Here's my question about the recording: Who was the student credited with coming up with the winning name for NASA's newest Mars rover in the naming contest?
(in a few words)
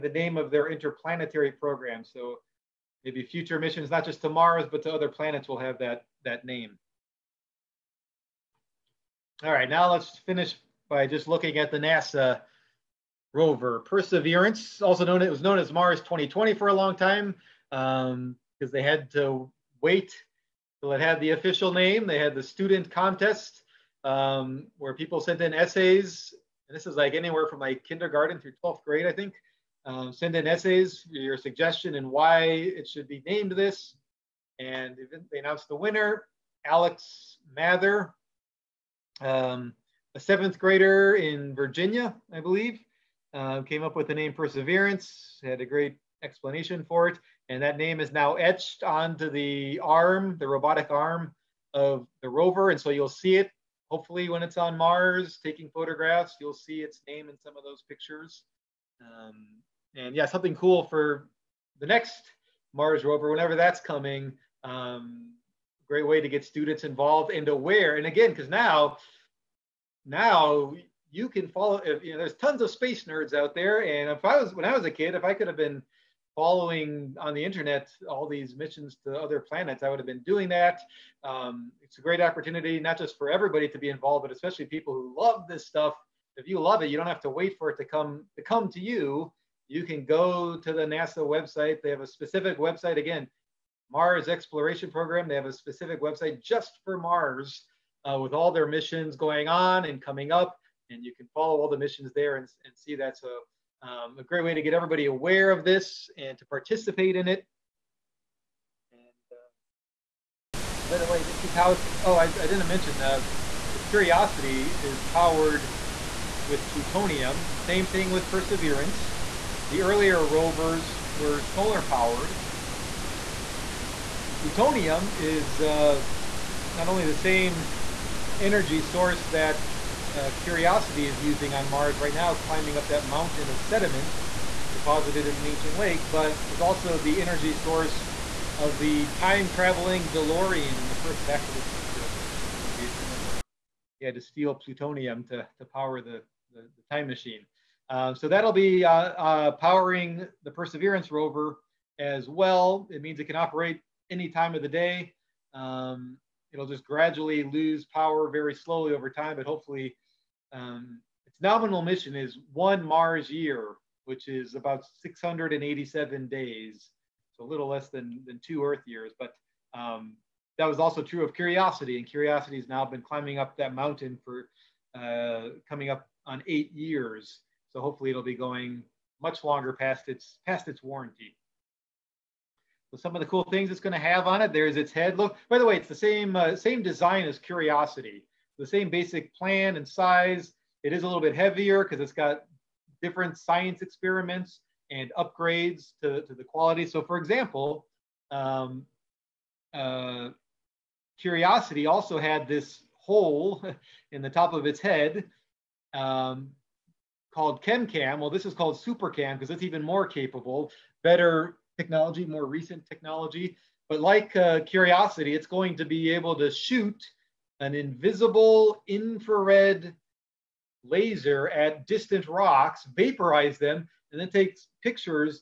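Alex Mather.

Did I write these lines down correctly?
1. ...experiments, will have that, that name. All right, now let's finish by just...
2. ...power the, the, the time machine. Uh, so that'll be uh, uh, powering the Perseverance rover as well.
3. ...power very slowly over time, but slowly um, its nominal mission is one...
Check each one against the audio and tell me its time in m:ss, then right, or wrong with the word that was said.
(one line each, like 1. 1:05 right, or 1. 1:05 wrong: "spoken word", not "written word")
1. 0:05 wrong: "planets", not "experiments"
2. 2:25 right
3. 2:37 wrong: "hopefully", not "slowly".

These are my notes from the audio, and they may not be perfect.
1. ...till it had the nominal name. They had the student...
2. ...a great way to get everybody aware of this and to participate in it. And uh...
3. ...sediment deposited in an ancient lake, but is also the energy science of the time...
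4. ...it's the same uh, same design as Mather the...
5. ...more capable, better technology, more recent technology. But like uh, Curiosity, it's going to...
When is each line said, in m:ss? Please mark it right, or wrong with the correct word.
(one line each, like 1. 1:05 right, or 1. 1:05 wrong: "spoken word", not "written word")
1. 0:20 wrong: "official", not "nominal"
2. 1:44 right
3. 2:13 wrong: "source", not "science"
4. 3:05 wrong: "Curiosity", not "Mather"
5. 3:29 right.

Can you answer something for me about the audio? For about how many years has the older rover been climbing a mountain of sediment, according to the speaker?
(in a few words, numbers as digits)
8.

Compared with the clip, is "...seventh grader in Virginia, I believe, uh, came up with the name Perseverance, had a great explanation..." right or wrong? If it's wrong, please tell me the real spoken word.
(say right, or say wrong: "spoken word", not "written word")
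right.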